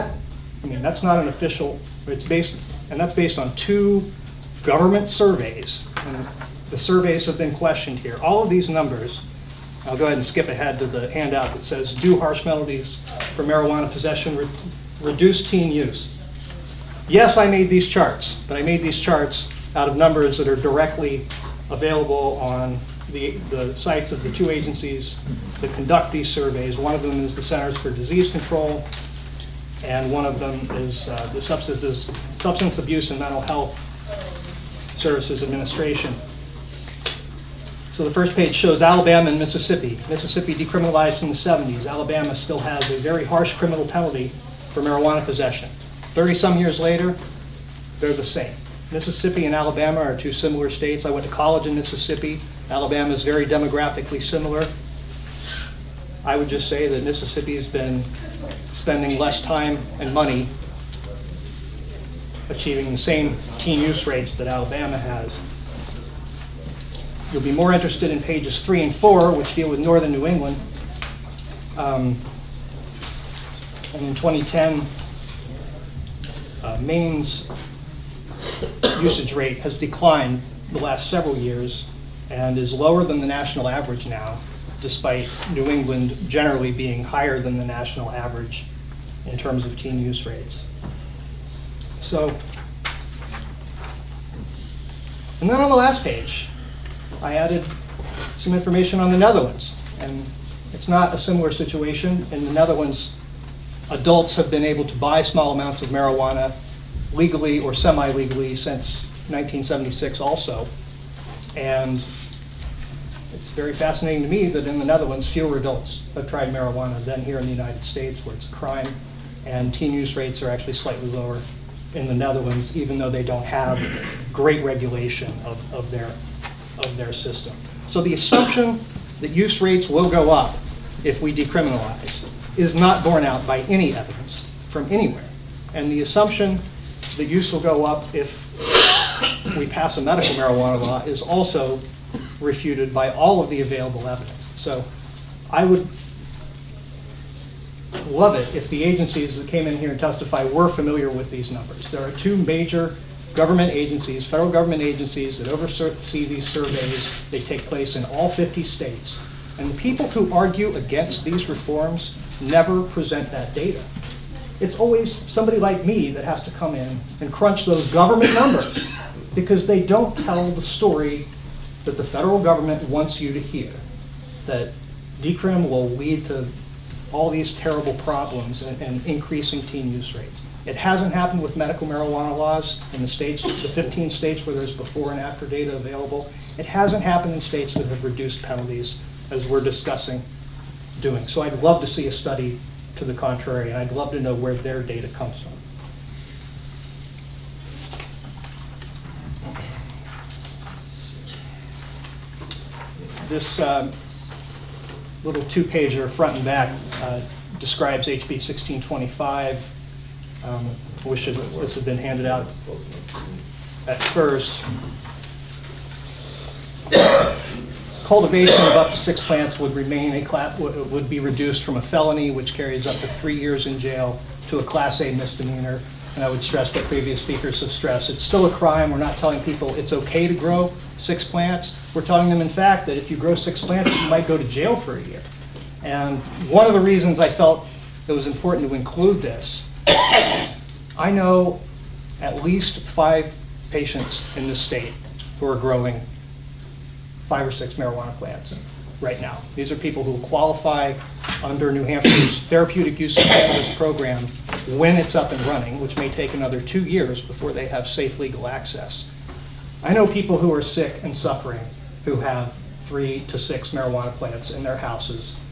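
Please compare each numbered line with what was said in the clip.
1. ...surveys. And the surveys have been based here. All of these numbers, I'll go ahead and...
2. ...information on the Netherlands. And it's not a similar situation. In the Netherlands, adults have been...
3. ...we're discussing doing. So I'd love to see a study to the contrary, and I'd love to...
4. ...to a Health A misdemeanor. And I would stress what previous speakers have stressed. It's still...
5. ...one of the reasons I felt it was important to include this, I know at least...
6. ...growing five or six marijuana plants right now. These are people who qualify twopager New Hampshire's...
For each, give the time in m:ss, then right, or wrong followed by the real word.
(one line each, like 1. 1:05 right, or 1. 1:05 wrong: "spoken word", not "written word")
1. 0:05 wrong: "questioned", not "based"
2. 1:38 right
3. 3:09 right
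4. 3:44 wrong: "Class", not "Health"
5. 3:56 right
6. 4:05 wrong: "under", not "twopager".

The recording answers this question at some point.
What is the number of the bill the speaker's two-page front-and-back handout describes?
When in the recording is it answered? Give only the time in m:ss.
3:28.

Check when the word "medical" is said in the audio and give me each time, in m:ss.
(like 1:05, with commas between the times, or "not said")
2:20, 3:01.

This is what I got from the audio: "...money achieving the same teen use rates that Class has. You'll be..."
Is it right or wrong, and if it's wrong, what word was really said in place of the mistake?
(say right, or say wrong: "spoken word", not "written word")
wrong: "Alabama", not "Class".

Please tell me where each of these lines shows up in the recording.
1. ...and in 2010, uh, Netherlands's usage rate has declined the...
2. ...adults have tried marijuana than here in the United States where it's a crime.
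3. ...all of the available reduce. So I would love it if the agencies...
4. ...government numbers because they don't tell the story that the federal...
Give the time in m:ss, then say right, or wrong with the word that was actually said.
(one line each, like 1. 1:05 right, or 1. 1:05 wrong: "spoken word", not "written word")
1. 1:13 wrong: "Maine", not "Netherlands"
2. 1:55 right
3. 2:23 wrong: "evidence", not "reduce"
4. 2:47 right.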